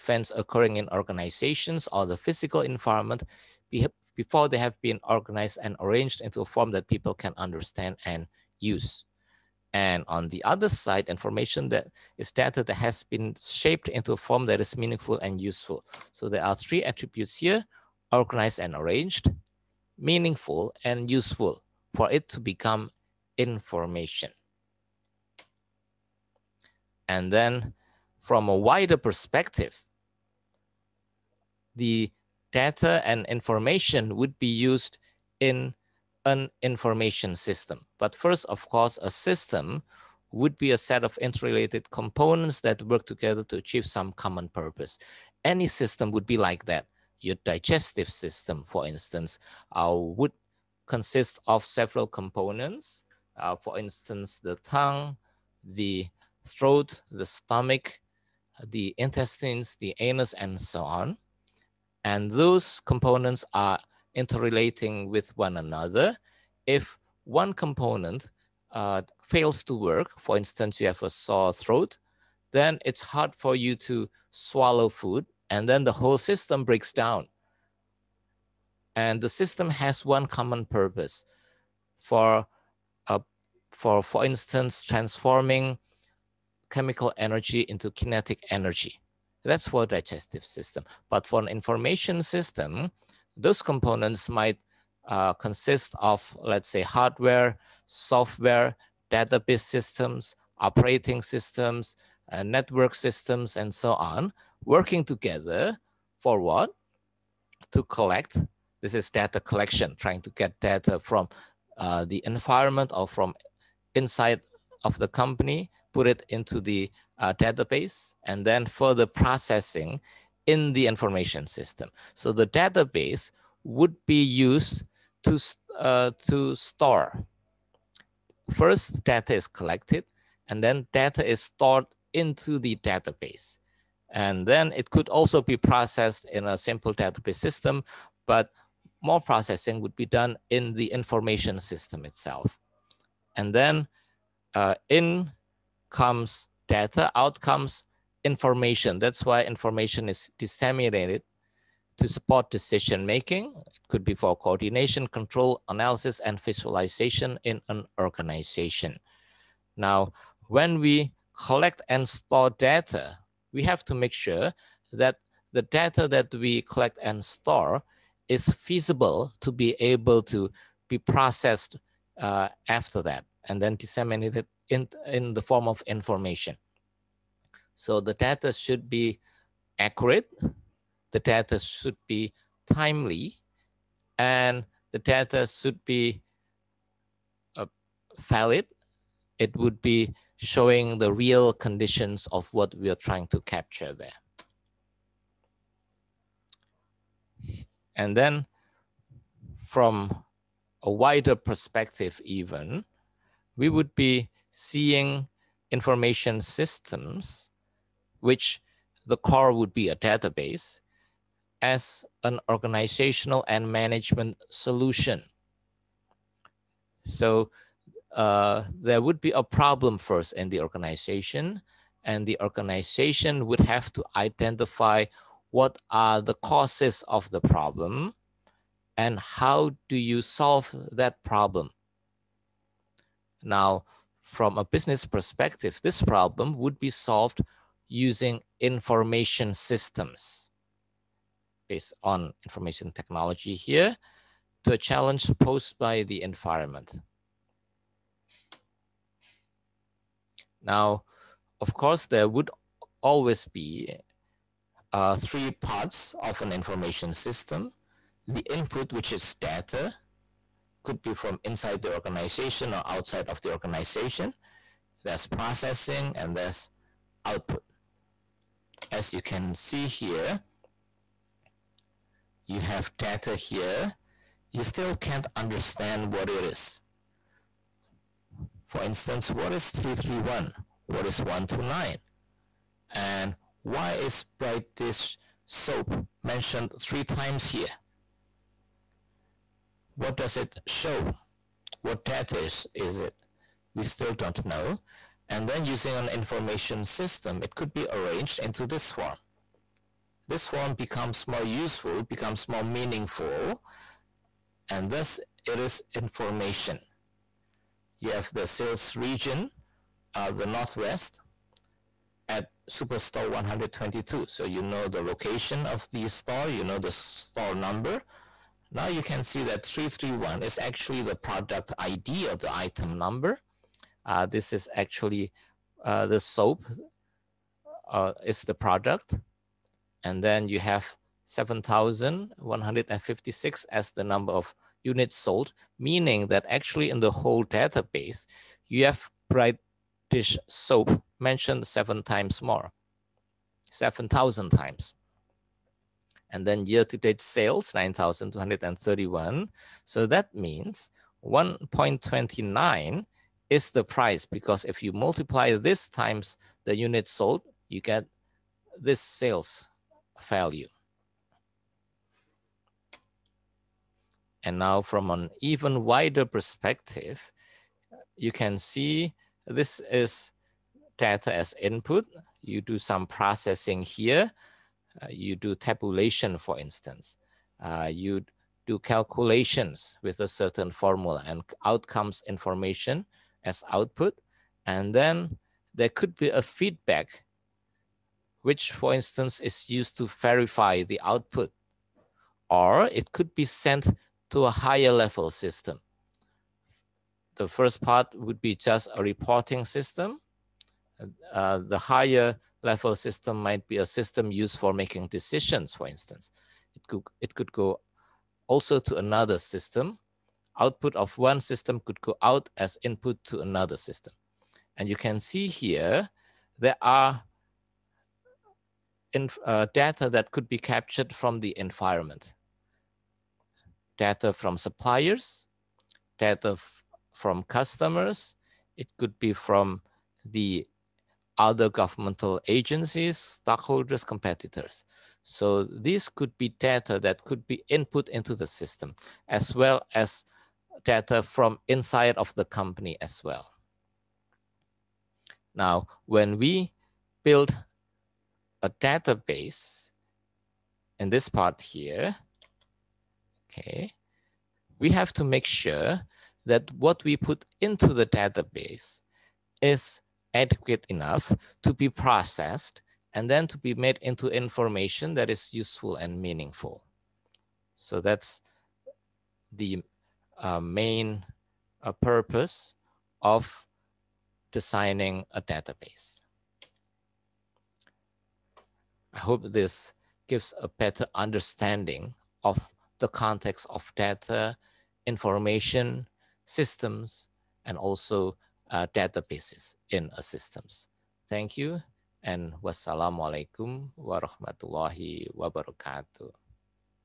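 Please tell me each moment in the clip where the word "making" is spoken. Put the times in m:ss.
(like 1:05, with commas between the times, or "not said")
2:33, 6:44.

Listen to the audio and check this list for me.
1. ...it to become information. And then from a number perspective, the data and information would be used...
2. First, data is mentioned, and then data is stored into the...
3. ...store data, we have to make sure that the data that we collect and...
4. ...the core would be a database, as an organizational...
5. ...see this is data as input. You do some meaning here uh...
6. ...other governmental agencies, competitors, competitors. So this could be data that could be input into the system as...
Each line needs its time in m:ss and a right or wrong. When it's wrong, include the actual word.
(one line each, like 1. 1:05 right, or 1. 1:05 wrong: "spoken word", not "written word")
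1. 0:22 wrong: "wider", not "number"
2. 2:08 wrong: "collected", not "mentioned"
3. 2:42 right
4. 3:29 right
5. 6:08 wrong: "processing", not "meaning"
6. 7:11 wrong: "stockholders", not "competitors".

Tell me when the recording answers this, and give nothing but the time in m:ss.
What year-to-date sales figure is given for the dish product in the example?
5:47.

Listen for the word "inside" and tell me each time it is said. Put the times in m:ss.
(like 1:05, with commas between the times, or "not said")
1:53, 4:21, 7:21.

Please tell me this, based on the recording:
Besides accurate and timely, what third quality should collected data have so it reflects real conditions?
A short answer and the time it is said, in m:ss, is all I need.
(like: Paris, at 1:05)
Valid, at 3:08.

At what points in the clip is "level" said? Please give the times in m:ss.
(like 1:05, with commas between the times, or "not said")
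6:34, 6:42.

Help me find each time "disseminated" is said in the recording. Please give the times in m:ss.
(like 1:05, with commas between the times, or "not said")
2:30, 2:53.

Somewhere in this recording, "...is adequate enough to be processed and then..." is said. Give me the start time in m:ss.
7:39.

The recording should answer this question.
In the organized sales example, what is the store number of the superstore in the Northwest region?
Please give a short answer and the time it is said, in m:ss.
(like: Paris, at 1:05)
122, at 5:13.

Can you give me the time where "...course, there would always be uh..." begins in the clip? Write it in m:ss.
4:11.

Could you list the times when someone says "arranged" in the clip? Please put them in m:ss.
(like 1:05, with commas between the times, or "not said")
0:05, 0:18, 4:57.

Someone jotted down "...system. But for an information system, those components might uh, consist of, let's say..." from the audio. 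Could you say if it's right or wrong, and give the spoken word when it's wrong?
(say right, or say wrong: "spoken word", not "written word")
right.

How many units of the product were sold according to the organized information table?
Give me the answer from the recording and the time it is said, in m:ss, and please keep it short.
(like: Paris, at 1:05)
7,156, at 5:31.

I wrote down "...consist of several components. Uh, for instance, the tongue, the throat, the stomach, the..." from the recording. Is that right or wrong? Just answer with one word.
right.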